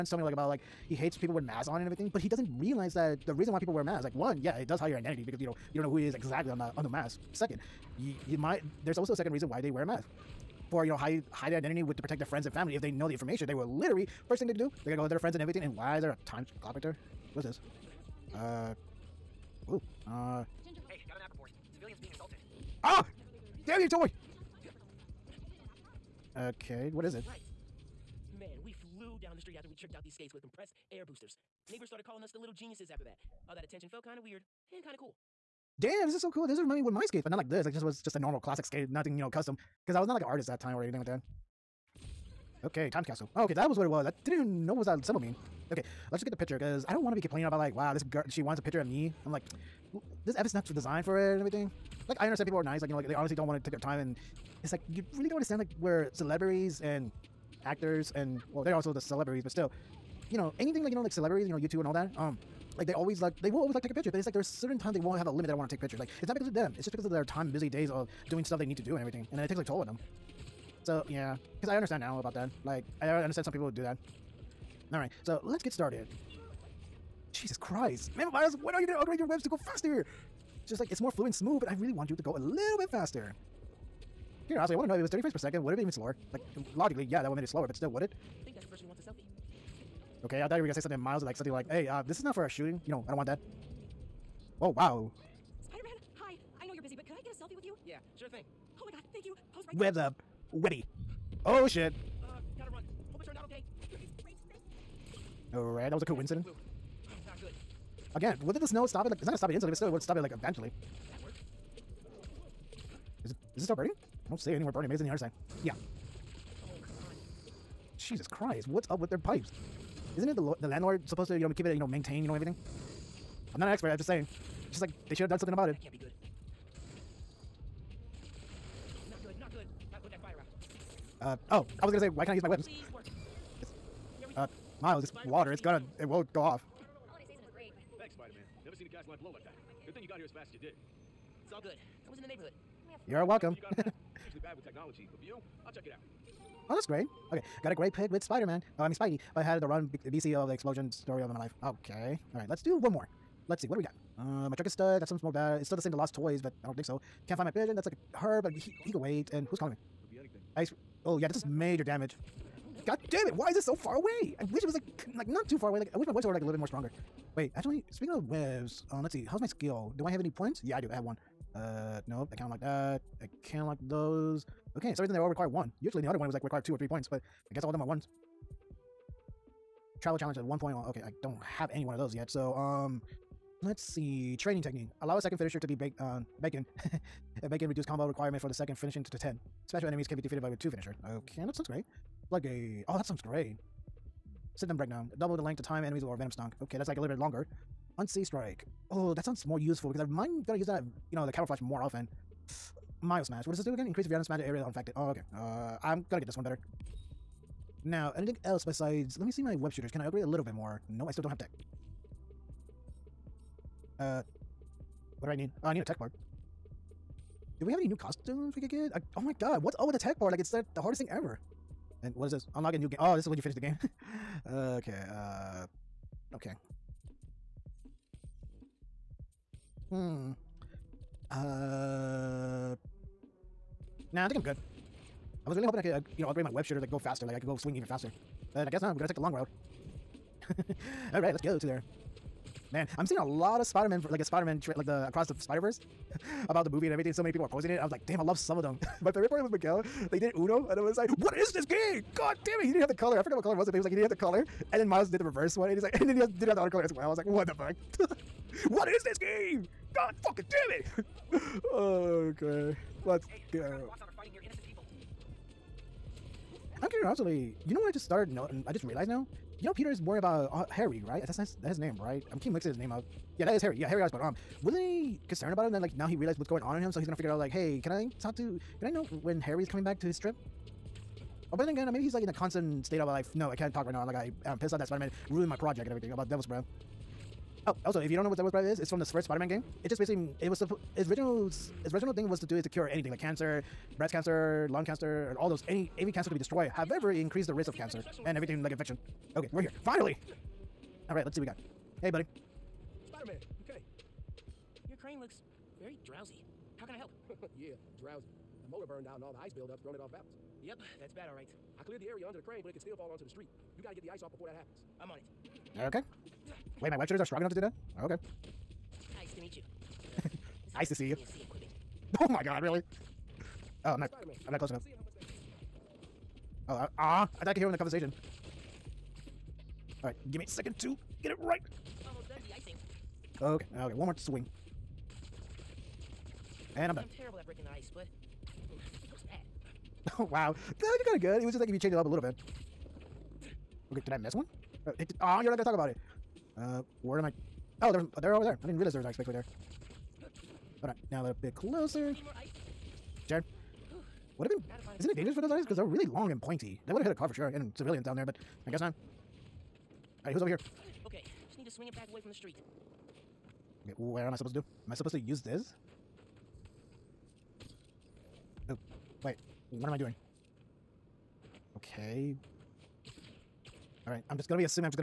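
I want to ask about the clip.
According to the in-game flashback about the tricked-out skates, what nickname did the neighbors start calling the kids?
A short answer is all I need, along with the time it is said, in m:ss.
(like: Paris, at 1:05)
the little geniuses, at 0:32.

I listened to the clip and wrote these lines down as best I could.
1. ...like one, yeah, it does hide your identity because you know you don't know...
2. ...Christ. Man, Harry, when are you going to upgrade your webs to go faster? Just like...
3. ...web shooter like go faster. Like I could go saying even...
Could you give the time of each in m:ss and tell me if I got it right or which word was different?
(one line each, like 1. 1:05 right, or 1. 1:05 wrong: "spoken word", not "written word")
1. 0:04 right
2. 1:17 wrong: "Miles", not "Harry"
3. 3:56 wrong: "swing", not "saying".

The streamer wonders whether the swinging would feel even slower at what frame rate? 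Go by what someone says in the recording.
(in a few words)
30 frames per second.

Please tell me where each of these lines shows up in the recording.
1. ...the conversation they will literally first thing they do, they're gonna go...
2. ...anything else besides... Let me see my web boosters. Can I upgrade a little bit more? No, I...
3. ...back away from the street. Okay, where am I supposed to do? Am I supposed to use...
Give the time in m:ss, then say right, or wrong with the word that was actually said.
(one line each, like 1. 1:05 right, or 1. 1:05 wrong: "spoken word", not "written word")
1. 0:13 wrong: "information", not "conversation"
2. 3:28 wrong: "shooters", not "boosters"
3. 6:01 right.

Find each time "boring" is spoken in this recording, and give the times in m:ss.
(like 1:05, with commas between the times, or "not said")
not said.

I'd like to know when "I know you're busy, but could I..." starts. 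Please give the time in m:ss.
1:36.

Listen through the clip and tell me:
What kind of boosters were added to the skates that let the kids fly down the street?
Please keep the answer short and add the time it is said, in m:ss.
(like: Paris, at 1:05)
compressed air boosters, at 0:30.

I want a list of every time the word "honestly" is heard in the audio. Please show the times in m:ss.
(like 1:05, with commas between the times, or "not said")
0:53, 1:24.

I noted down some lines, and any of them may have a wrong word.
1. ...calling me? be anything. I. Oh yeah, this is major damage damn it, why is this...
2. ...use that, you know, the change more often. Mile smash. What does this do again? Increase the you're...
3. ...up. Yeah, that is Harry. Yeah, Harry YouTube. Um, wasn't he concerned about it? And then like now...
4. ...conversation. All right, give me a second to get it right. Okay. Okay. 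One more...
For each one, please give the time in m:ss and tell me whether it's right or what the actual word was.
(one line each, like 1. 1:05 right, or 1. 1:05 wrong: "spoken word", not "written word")
1. 2:39 right
2. 3:20 wrong: "camouflage", not "change"
3. 4:32 wrong: "Osborn", not "YouTube"
4. 5:27 right.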